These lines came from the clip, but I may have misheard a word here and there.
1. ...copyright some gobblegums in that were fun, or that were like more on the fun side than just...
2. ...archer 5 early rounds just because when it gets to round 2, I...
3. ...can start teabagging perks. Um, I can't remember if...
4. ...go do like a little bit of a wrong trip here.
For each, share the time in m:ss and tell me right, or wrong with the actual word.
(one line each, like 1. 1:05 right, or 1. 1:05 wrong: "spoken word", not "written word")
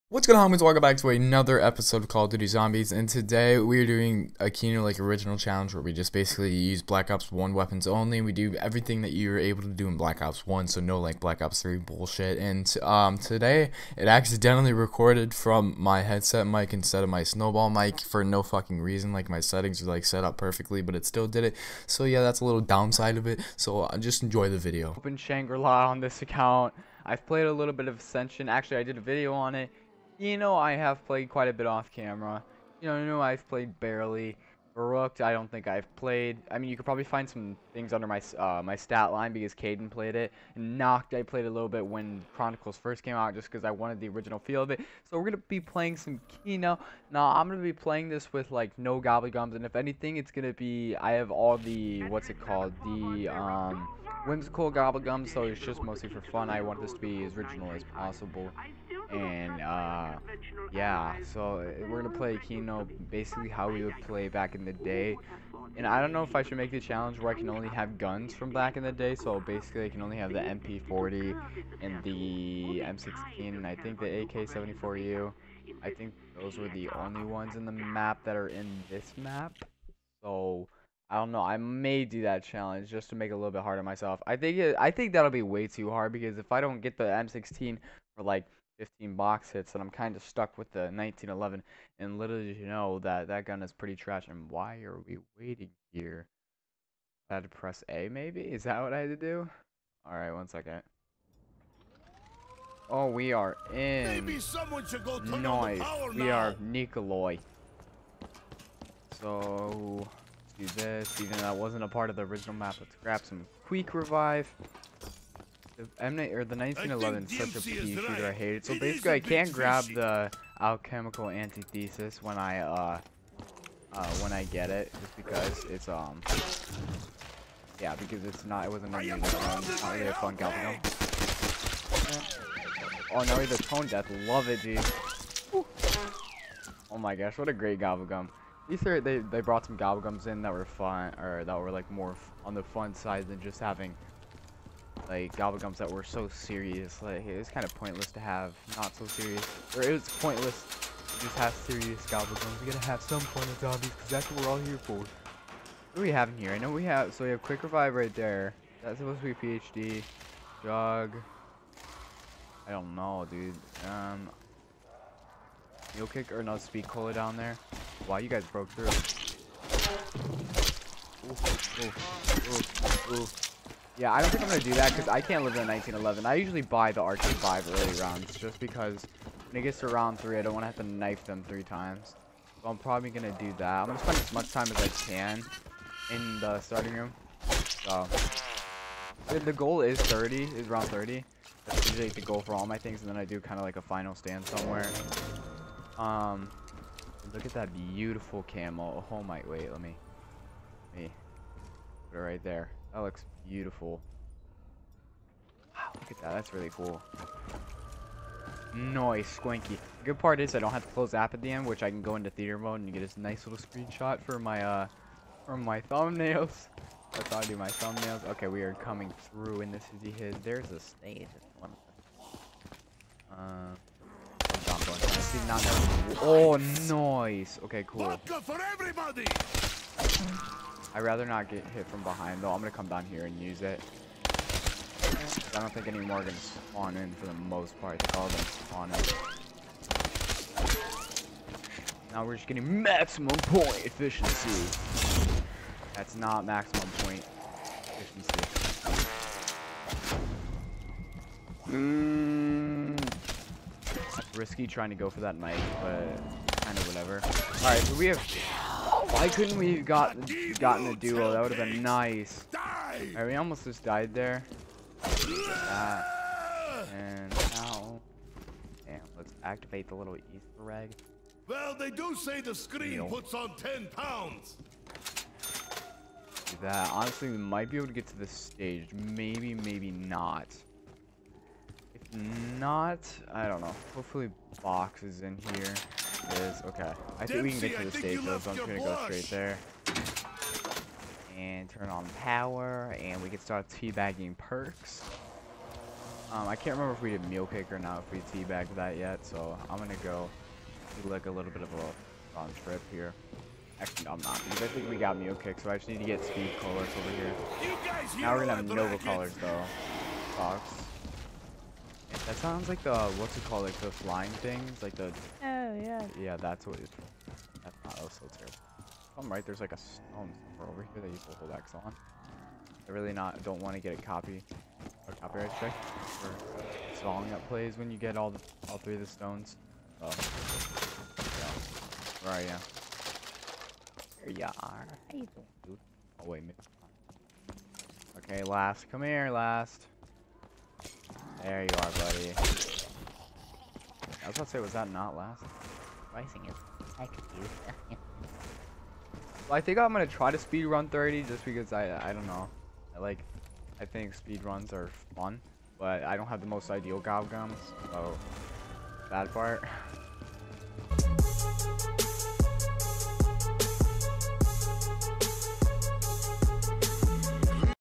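1. 2:19 wrong: "brought", not "copyright"
2. 2:57 wrong: "3", not "2"
3. 4:53 right
4. 5:00 right.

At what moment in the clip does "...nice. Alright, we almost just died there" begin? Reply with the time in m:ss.
4:21.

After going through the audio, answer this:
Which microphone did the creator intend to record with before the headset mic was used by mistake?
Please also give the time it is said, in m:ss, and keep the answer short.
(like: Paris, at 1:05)
Snowball mic, at 0:17.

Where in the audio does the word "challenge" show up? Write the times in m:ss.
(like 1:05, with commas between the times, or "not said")
0:05, 1:06, 1:22.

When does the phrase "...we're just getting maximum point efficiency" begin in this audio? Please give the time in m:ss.
4:02.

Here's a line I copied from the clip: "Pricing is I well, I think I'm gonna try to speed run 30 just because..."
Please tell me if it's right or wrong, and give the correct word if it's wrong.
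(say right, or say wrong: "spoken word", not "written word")
right.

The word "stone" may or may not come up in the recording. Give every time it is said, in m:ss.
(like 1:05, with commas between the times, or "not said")
5:19, 5:29.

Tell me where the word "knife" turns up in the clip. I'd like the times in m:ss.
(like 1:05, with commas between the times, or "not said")
3:00, 4:15.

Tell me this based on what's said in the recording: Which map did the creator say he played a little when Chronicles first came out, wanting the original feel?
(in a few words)
Nacht.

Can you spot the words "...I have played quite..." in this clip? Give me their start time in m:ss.
0:30.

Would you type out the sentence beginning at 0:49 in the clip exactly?
And if anything, it's going to be, I have all the, what's it called?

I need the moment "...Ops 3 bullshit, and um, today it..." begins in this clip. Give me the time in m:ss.
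0:11.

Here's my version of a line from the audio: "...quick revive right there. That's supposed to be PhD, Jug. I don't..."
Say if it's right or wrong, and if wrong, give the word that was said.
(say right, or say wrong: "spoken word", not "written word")
right.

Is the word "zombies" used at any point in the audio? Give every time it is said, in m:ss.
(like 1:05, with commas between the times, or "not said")
0:02, 2:33.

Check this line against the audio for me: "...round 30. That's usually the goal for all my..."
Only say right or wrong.
right.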